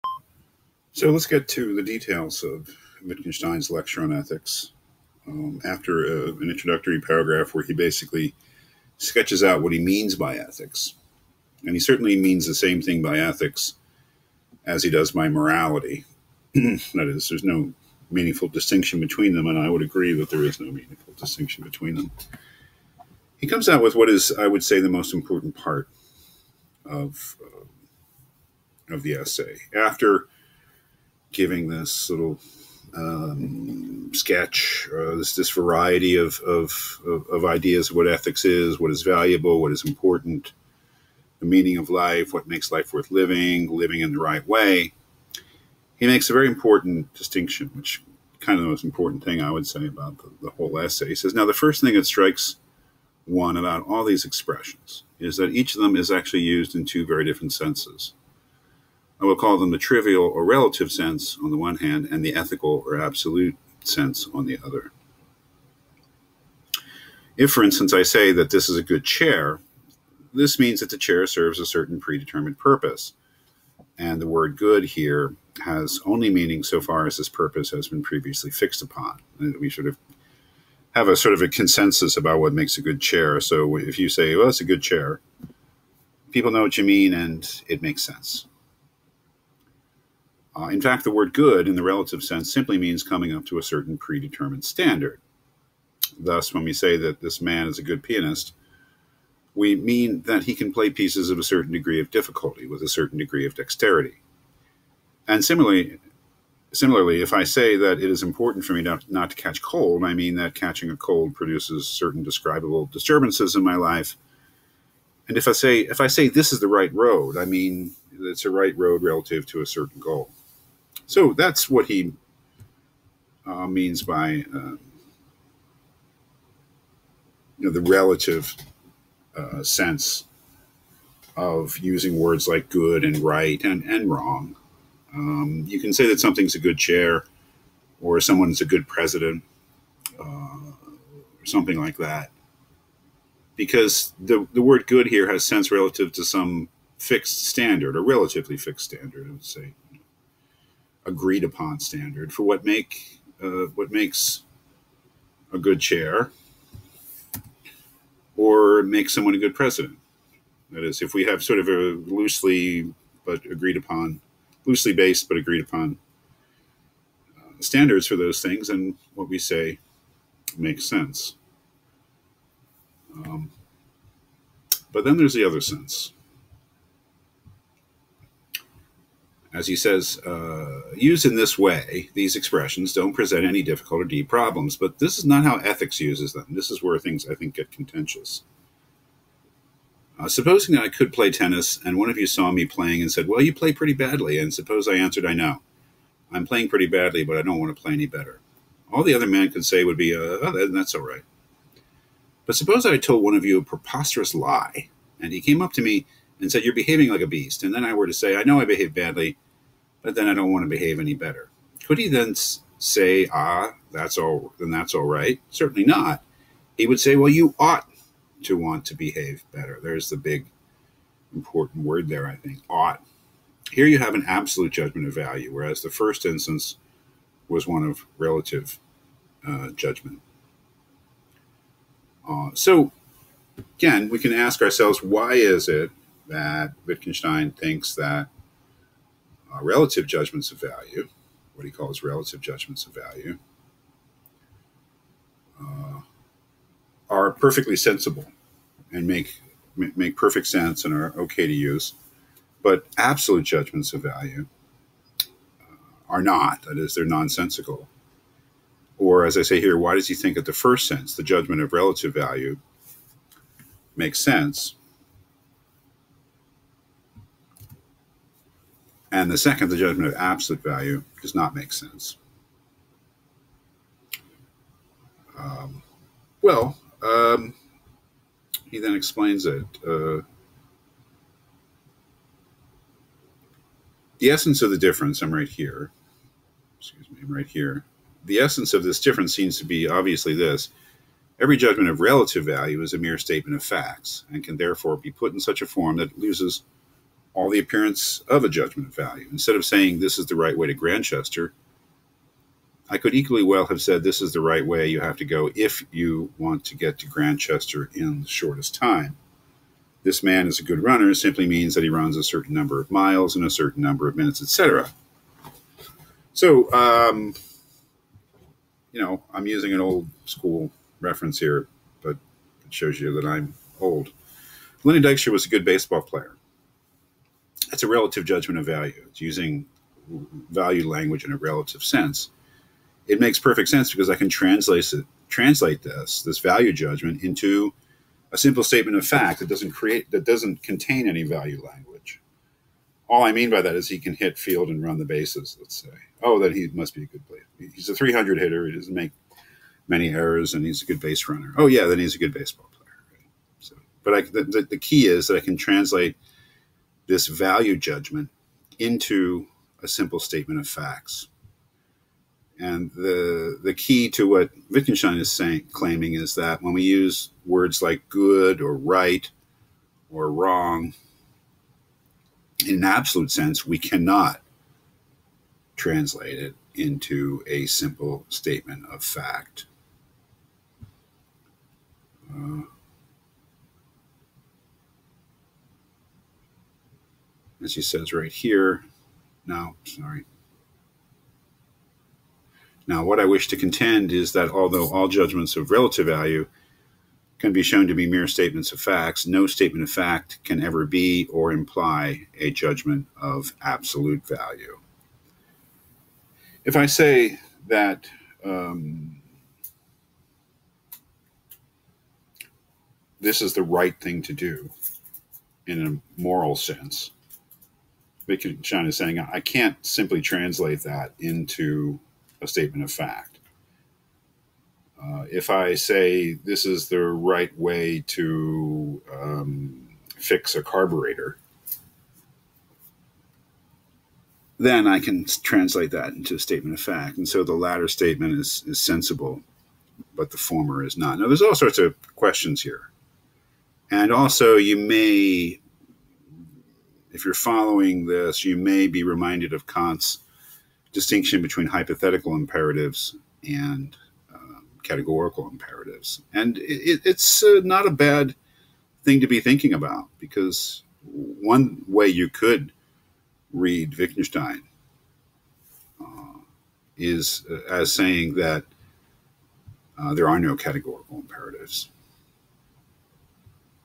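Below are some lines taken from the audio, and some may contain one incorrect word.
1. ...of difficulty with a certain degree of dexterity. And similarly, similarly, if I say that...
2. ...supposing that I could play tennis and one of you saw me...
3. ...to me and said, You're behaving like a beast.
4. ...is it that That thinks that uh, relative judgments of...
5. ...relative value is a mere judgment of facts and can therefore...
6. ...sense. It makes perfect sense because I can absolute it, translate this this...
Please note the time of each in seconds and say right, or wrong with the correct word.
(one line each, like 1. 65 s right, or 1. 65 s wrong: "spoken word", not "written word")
1. 102 s right
2. 190 s right
3. 205 s right
4. 235 s wrong: "Wittgenstein", not "That"
5. 291 s wrong: "statement", not "judgment"
6. 331 s wrong: "translate", not "absolute".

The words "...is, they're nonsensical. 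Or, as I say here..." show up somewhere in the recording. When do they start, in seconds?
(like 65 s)
256 s.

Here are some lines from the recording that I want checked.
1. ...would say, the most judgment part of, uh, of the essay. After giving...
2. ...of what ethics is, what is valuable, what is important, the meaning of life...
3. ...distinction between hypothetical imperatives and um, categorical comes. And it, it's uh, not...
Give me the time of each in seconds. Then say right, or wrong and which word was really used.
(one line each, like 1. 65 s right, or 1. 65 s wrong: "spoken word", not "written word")
1. 24 s wrong: "important", not "judgment"
2. 37 s right
3. 450 s wrong: "imperatives", not "comes".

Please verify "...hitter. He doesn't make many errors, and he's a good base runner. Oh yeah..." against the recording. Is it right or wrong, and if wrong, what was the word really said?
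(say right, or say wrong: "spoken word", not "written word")
right.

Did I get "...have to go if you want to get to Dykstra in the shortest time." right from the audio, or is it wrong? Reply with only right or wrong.
wrong.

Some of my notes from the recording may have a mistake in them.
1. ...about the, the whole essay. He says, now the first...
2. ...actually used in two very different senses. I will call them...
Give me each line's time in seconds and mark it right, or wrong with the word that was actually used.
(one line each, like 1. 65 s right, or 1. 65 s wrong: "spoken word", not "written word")
1. 49 s right
2. 56 s right.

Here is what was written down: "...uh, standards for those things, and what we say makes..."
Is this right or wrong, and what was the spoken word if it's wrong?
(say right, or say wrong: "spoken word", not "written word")
right.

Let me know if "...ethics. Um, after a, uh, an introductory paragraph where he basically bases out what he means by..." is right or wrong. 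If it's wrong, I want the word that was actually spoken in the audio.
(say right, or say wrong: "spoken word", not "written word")
wrong: "sketches", not "bases".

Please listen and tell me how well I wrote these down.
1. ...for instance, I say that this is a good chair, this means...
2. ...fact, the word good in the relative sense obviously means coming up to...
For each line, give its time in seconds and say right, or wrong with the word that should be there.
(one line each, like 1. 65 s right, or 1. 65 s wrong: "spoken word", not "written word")
1. 67 s right
2. 90 s wrong: "simply", not "obviously".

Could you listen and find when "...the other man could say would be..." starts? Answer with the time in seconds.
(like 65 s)
199 s.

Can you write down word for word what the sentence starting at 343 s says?
All I mean by that is he can hit field and run the bases.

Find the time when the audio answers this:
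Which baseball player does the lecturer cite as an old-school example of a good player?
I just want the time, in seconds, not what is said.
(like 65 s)
324 s.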